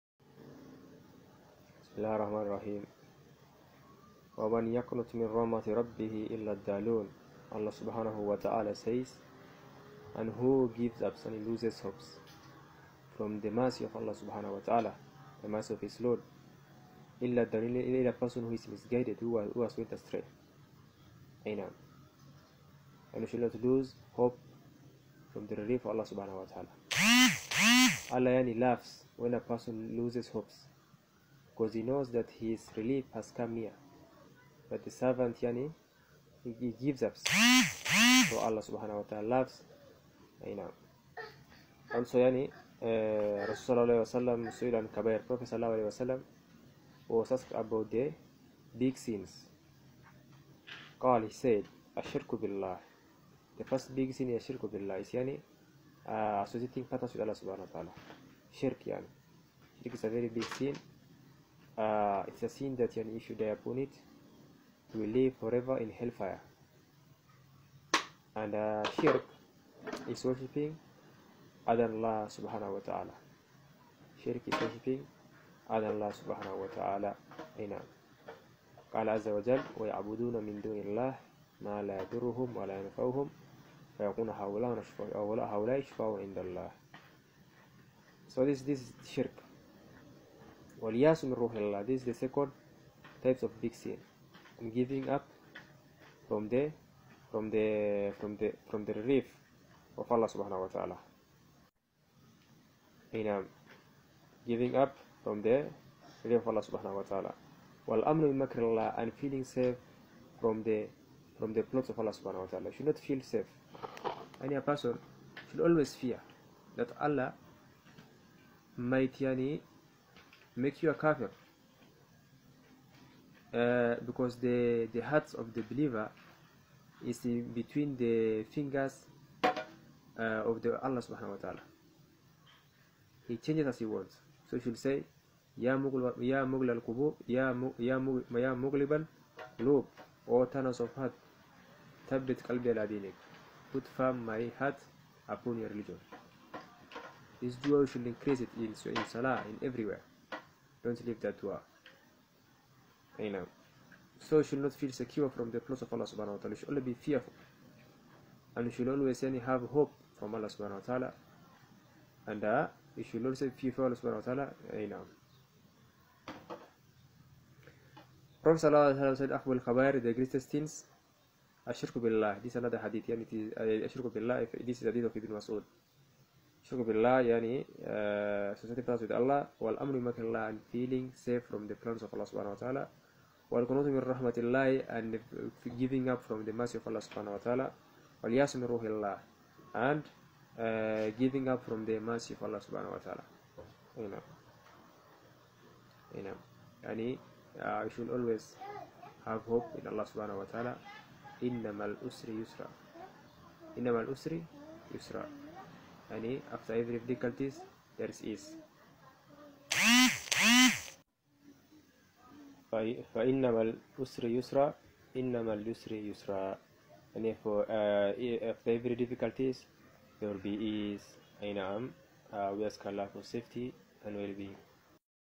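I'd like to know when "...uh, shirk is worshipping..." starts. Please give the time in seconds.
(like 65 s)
68 s.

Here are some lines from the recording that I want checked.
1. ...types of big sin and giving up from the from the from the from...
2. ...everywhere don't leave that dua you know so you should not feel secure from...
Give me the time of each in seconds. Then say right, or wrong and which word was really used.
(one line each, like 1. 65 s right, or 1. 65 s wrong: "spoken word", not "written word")
1. 93 s right
2. 149 s right.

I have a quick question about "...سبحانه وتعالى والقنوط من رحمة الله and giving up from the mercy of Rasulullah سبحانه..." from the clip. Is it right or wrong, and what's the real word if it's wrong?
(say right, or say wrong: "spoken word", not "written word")
wrong: "Allah", not "Rasulullah".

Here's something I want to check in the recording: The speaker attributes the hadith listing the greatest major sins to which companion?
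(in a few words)
Ibn Mas'ud.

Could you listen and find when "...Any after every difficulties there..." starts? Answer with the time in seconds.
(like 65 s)
206 s.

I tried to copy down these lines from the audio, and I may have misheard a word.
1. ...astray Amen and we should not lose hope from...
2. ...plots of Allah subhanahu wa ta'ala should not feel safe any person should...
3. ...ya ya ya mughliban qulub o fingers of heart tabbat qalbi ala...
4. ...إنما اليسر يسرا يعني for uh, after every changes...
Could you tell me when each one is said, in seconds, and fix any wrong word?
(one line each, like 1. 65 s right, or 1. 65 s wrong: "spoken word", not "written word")
1. 19 s right
2. 111 s right
3. 137 s wrong: "turners", not "fingers"
4. 215 s wrong: "difficulties", not "changes".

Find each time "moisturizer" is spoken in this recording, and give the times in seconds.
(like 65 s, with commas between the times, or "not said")
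not said.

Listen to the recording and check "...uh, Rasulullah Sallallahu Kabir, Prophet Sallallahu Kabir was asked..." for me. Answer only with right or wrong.
wrong.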